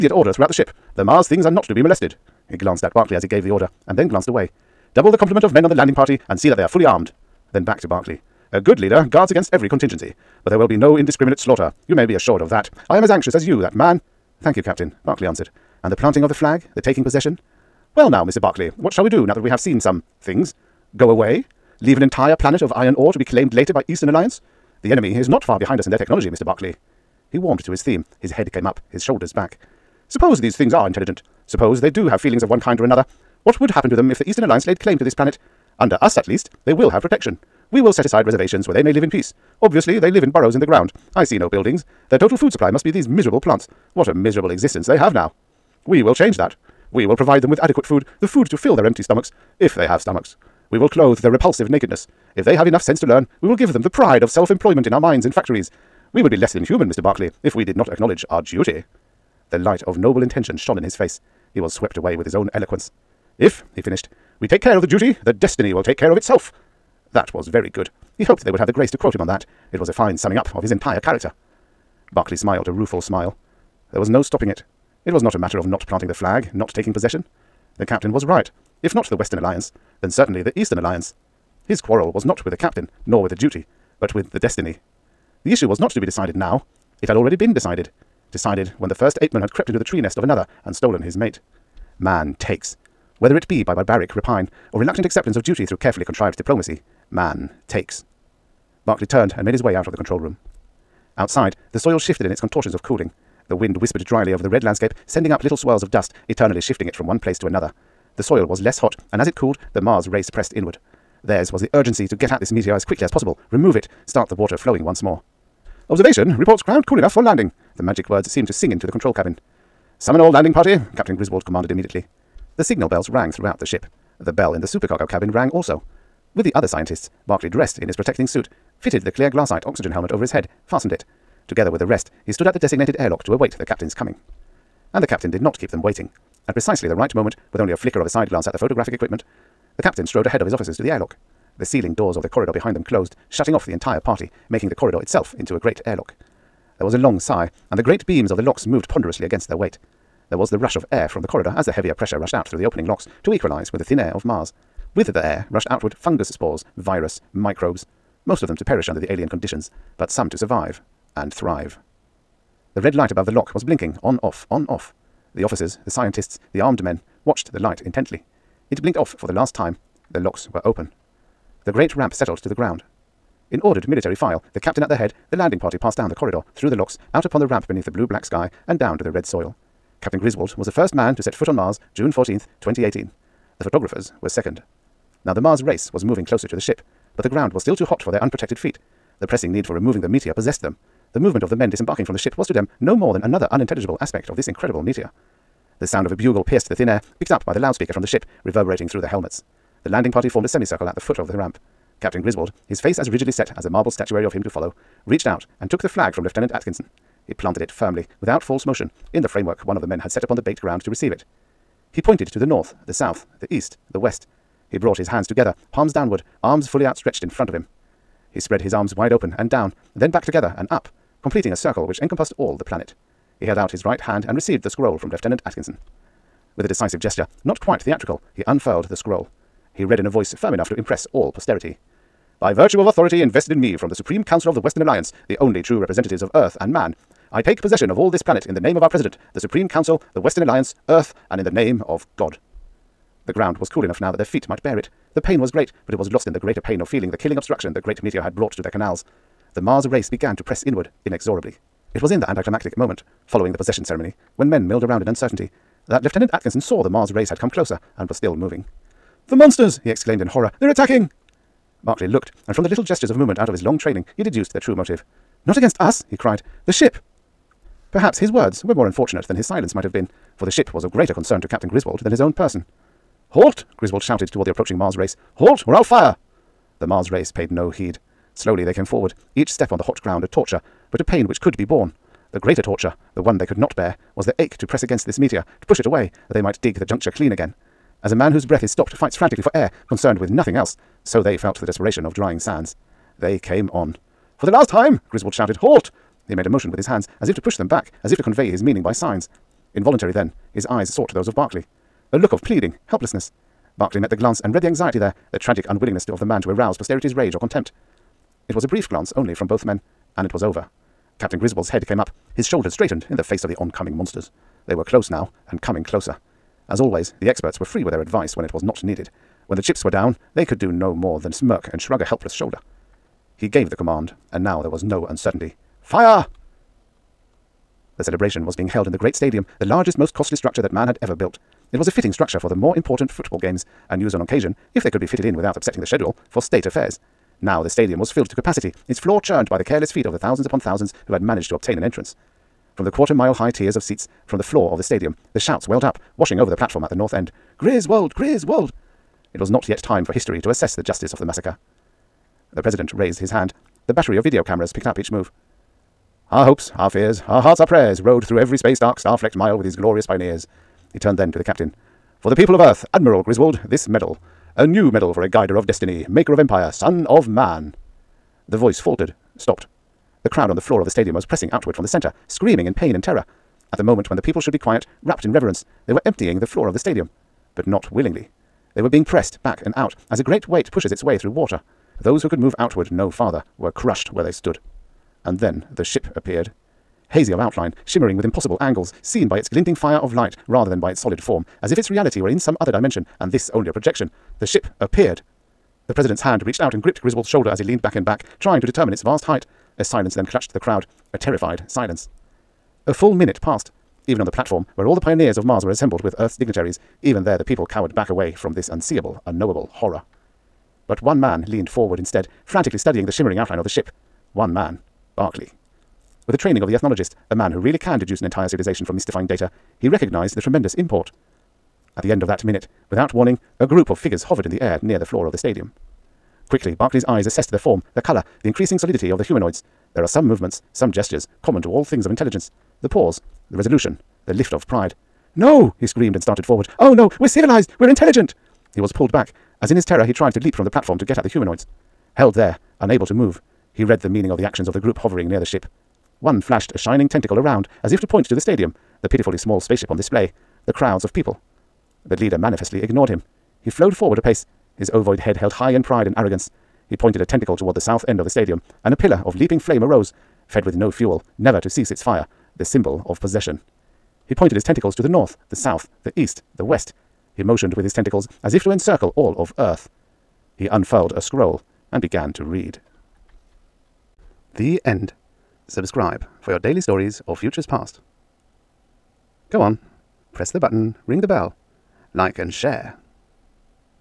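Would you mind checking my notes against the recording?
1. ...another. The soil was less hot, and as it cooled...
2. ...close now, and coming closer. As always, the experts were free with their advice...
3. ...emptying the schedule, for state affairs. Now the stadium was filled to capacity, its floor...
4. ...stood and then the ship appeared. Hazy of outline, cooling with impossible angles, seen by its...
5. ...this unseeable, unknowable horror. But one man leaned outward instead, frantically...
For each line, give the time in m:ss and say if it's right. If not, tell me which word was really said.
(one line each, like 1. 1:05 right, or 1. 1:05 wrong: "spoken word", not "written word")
1. 1:47 right
2. 5:14 right
3. 5:35 wrong: "upsetting", not "emptying"
4. 6:24 wrong: "shimmering", not "cooling"
5. 6:48 wrong: "forward", not "outward".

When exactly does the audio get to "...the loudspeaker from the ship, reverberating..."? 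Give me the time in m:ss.
3:17.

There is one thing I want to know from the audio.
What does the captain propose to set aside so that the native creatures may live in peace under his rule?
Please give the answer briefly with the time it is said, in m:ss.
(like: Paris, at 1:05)
Reservations, at 0:38.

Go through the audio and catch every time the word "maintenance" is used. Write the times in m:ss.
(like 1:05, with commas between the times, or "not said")
not said.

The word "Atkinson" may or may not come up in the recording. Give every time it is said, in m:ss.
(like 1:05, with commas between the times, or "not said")
3:26, 3:45, 4:16.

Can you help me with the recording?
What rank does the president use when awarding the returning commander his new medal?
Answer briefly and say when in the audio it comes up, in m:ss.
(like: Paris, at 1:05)
Admiral, at 6:02.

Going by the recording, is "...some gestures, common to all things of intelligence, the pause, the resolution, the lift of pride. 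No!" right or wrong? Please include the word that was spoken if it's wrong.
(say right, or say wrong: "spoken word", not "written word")
right.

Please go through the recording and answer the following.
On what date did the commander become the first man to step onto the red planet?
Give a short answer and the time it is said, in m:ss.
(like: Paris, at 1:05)
June 14, 2018, at 3:01.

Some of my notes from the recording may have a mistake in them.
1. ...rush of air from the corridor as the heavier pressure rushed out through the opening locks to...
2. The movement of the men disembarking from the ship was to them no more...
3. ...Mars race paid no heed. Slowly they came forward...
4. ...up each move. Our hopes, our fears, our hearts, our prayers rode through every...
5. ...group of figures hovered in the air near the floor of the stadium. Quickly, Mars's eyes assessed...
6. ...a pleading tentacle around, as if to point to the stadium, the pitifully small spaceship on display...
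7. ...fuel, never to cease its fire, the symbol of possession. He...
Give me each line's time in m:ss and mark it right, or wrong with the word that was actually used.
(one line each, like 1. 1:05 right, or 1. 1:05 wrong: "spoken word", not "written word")
1. 2:30 right
2. 3:11 right
3. 4:36 right
4. 5:54 right
5. 7:03 wrong: "Barclay", not "Mars"
6. 7:26 wrong: "shining", not "pleading"
7. 7:40 right.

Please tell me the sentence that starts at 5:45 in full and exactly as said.
The shouts welled up, washing over the platform at the north end.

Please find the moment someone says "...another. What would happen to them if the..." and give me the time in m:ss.
0:32.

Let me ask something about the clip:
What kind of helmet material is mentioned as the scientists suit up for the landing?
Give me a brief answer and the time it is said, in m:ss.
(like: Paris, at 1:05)
Glassite, at 2:09.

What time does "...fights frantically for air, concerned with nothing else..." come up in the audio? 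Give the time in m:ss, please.
4:48.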